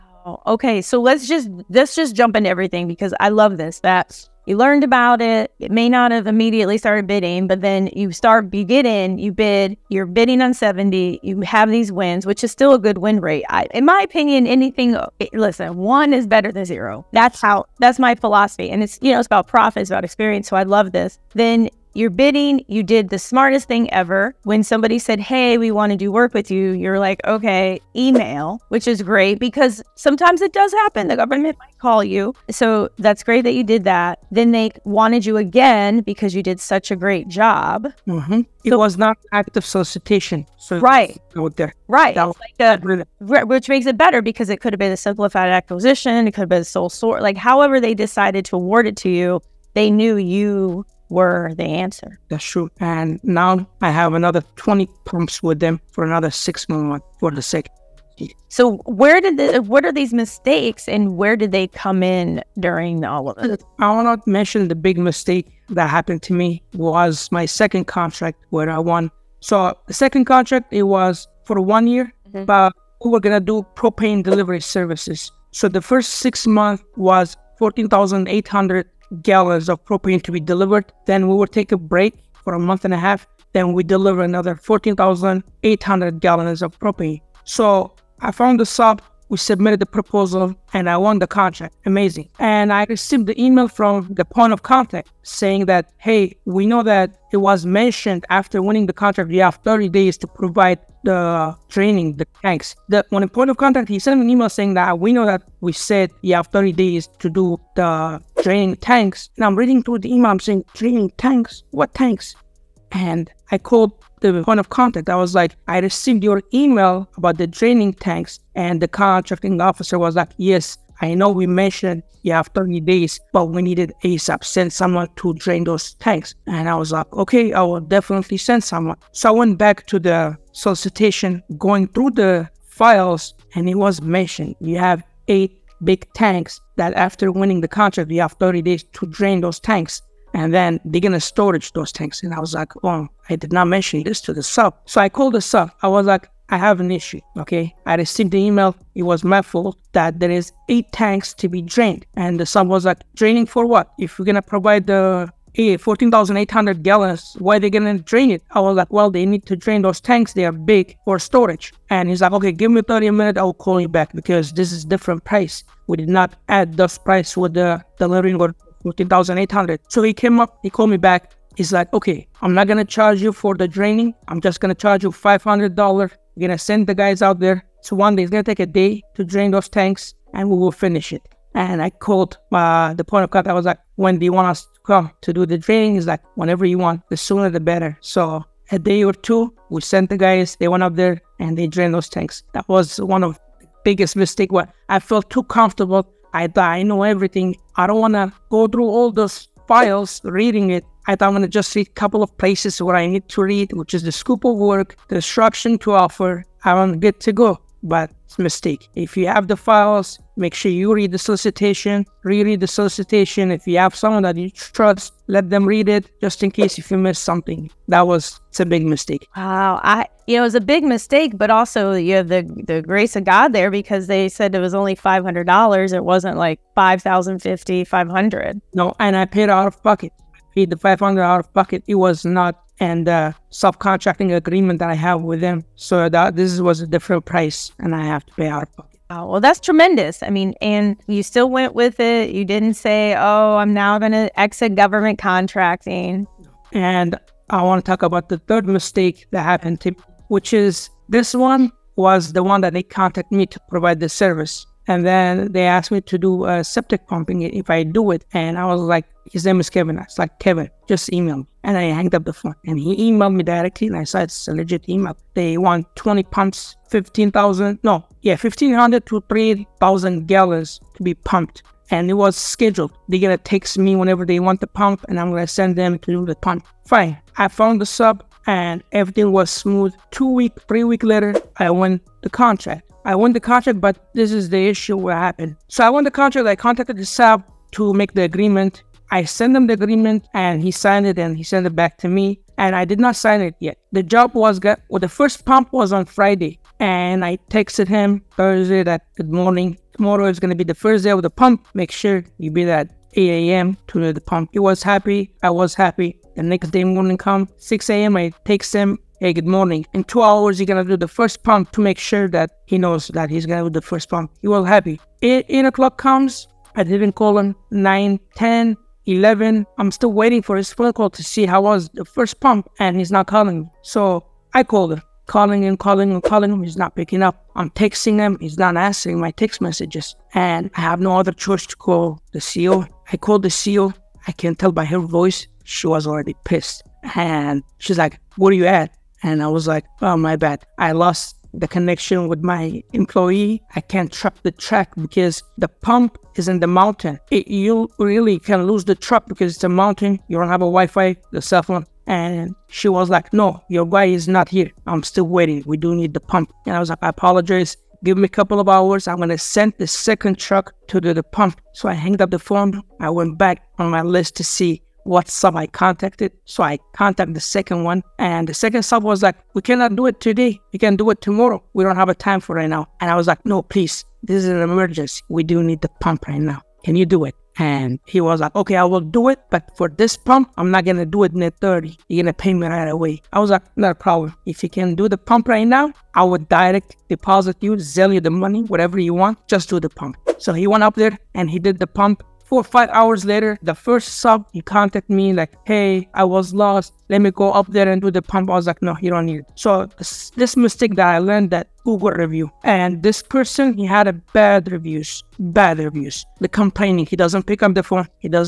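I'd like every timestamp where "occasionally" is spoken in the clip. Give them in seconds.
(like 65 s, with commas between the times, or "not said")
not said.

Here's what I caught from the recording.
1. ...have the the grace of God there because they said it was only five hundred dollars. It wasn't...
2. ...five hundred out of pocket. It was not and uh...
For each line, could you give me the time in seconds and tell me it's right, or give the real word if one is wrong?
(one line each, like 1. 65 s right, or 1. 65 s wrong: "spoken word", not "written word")
1. 222 s right
2. 230 s right.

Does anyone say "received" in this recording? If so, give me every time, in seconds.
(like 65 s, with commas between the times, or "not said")
92 s, 115 s, 147 s.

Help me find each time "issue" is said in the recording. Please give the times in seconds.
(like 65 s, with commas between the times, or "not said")
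146 s, 284 s.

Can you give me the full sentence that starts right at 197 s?
I don't want to go through all those files reading it.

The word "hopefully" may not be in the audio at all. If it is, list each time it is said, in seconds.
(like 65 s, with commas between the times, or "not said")
not said.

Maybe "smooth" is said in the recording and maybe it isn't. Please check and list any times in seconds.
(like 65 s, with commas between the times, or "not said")
279 s.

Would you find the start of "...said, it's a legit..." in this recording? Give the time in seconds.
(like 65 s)
264 s.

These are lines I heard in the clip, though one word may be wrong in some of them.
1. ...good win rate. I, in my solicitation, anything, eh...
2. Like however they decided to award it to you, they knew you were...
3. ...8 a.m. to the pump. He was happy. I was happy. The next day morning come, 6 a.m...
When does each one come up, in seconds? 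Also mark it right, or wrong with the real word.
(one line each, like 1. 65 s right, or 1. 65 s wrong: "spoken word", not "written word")
1. 12 s wrong: "opinion", not "solicitation"
2. 47 s right
3. 303 s right.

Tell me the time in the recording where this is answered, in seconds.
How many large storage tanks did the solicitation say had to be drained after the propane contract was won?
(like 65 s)
135 s.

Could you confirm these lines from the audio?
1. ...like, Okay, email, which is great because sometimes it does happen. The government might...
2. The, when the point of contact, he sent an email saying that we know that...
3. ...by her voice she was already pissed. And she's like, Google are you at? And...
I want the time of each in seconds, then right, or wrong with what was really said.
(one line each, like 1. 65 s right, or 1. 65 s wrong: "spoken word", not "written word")
1. 26 s right
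2. 102 s right
3. 334 s wrong: "Where", not "Google".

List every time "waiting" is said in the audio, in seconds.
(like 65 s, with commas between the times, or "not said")
320 s, 355 s.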